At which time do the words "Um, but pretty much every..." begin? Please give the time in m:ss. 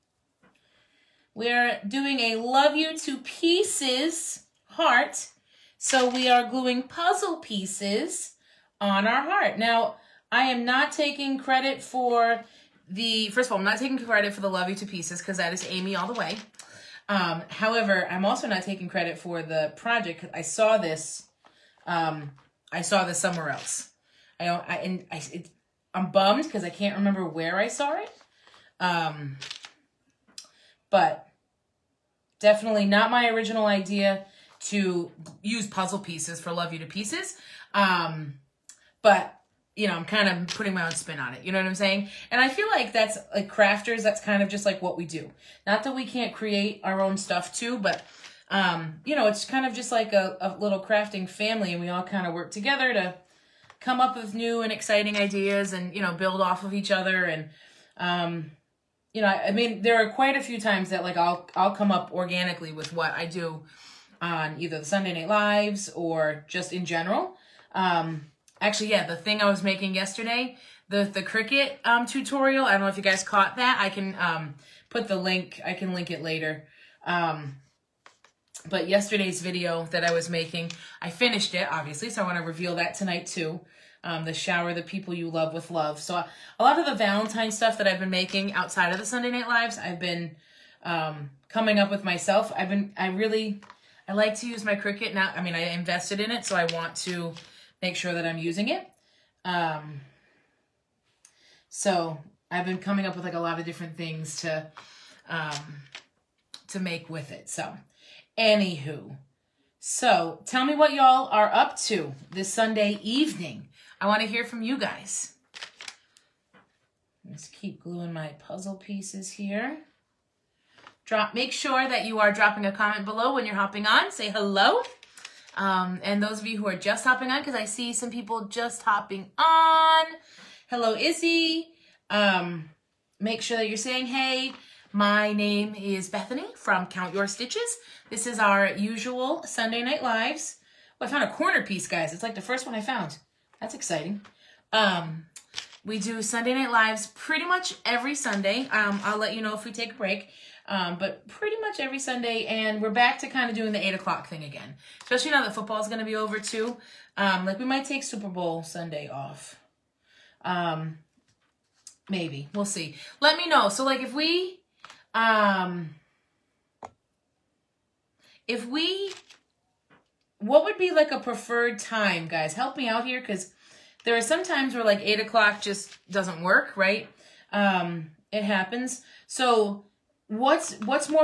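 2:30.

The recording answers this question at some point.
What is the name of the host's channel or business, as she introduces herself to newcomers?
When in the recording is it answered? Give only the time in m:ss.
2:16.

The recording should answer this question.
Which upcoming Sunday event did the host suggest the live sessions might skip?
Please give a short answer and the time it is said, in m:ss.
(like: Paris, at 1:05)
Super Bowl Sunday, at 2:38.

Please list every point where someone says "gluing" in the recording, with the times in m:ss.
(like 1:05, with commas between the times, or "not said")
0:06, 1:57.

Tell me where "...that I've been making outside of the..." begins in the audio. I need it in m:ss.
1:27.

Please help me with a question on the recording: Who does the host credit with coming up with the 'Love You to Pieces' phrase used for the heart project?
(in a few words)
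Amy.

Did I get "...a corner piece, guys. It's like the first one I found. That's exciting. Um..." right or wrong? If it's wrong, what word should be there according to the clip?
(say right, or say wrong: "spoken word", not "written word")
right.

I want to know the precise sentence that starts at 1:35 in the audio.
I mean, I invested in it, so I want to make sure that I'm using it.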